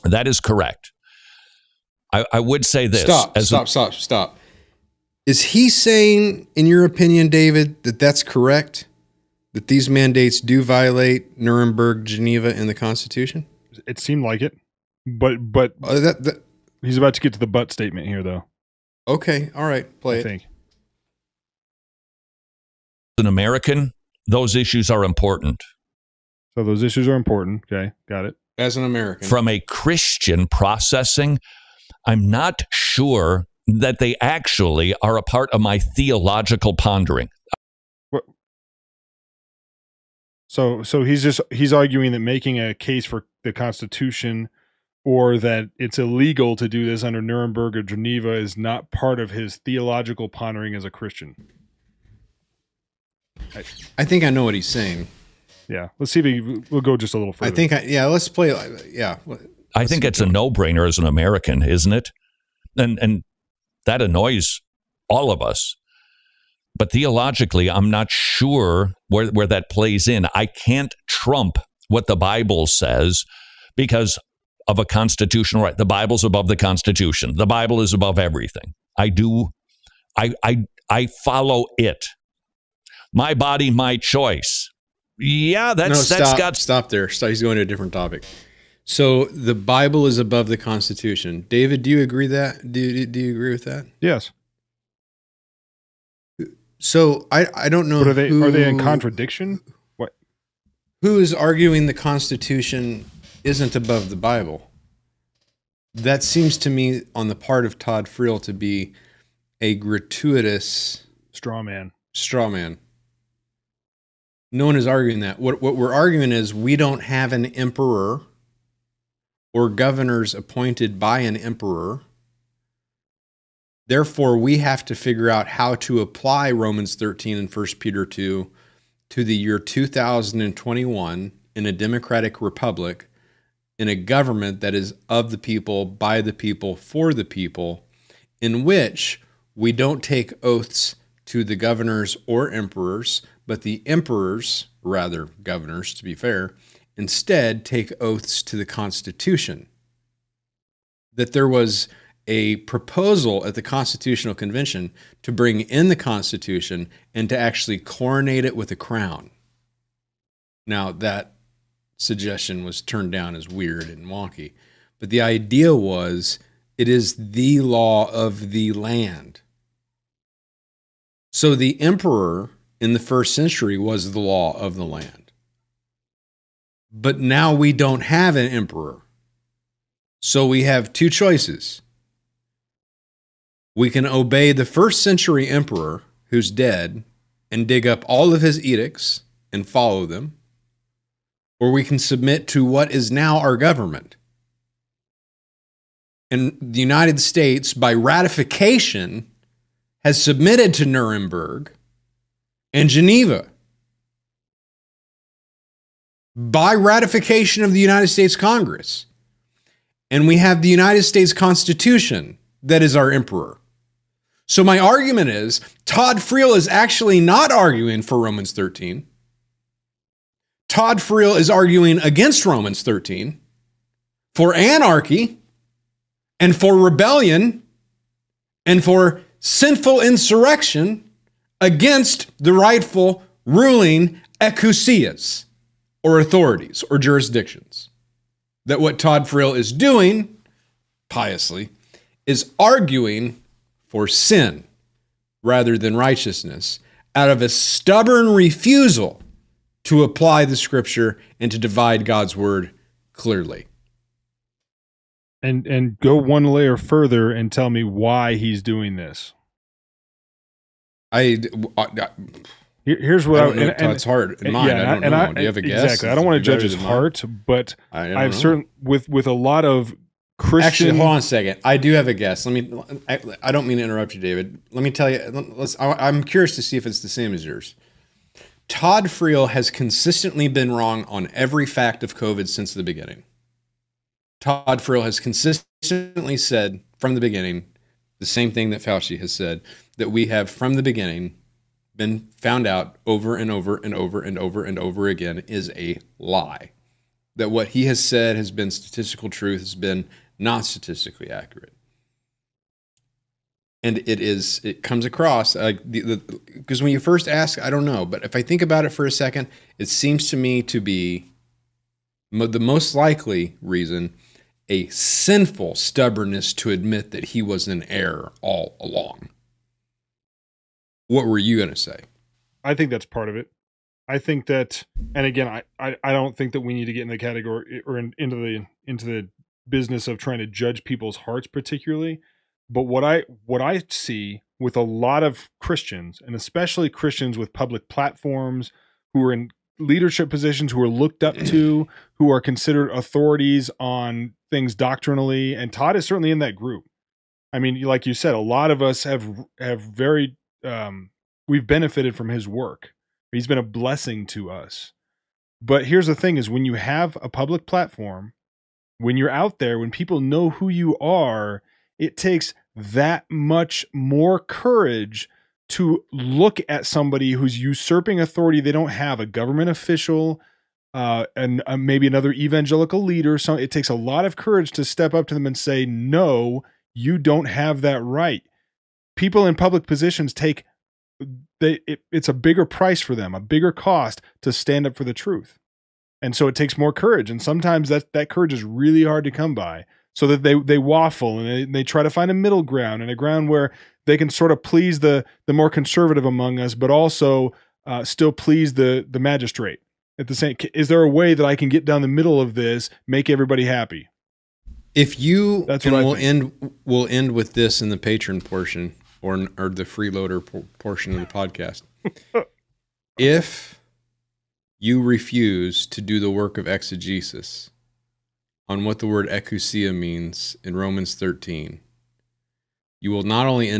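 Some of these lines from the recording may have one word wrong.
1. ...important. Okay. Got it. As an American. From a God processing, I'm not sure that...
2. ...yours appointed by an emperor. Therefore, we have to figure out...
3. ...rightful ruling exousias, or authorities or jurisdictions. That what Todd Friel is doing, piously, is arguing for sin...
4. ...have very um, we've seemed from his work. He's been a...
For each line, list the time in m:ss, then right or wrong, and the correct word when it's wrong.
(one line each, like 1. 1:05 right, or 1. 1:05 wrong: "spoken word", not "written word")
1. 0:27 wrong: "Christian", not "God"
2. 1:59 wrong: "governors", not "yours"
3. 3:52 right
4. 5:49 wrong: "benefited", not "seemed".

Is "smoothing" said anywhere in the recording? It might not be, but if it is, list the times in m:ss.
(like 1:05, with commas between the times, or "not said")
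not said.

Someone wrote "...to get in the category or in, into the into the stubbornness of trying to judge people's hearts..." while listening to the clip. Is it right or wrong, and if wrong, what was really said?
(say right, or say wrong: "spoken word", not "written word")
wrong: "business", not "stubbornness".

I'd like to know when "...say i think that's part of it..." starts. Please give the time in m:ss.
5:21.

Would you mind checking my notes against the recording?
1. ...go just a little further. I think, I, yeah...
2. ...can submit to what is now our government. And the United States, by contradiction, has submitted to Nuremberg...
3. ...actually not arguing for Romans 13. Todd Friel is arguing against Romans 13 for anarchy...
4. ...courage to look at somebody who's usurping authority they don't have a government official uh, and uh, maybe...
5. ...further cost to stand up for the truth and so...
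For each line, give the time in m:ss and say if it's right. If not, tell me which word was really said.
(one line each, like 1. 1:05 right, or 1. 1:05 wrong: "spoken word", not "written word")
1. 0:56 right
2. 3:11 wrong: "ratification", not "contradiction"
3. 3:36 right
4. 6:04 right
5. 6:23 wrong: "bigger", not "further".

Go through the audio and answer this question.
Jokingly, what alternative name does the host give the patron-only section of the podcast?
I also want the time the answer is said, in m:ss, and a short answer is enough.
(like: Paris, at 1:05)
freeloader portion, at 6:49.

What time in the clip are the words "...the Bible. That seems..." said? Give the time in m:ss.
1:44.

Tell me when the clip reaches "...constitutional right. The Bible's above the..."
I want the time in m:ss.
1:14.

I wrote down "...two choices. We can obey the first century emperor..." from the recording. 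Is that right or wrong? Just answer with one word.
right.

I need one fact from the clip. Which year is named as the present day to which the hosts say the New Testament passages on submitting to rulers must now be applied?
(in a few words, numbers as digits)
2021.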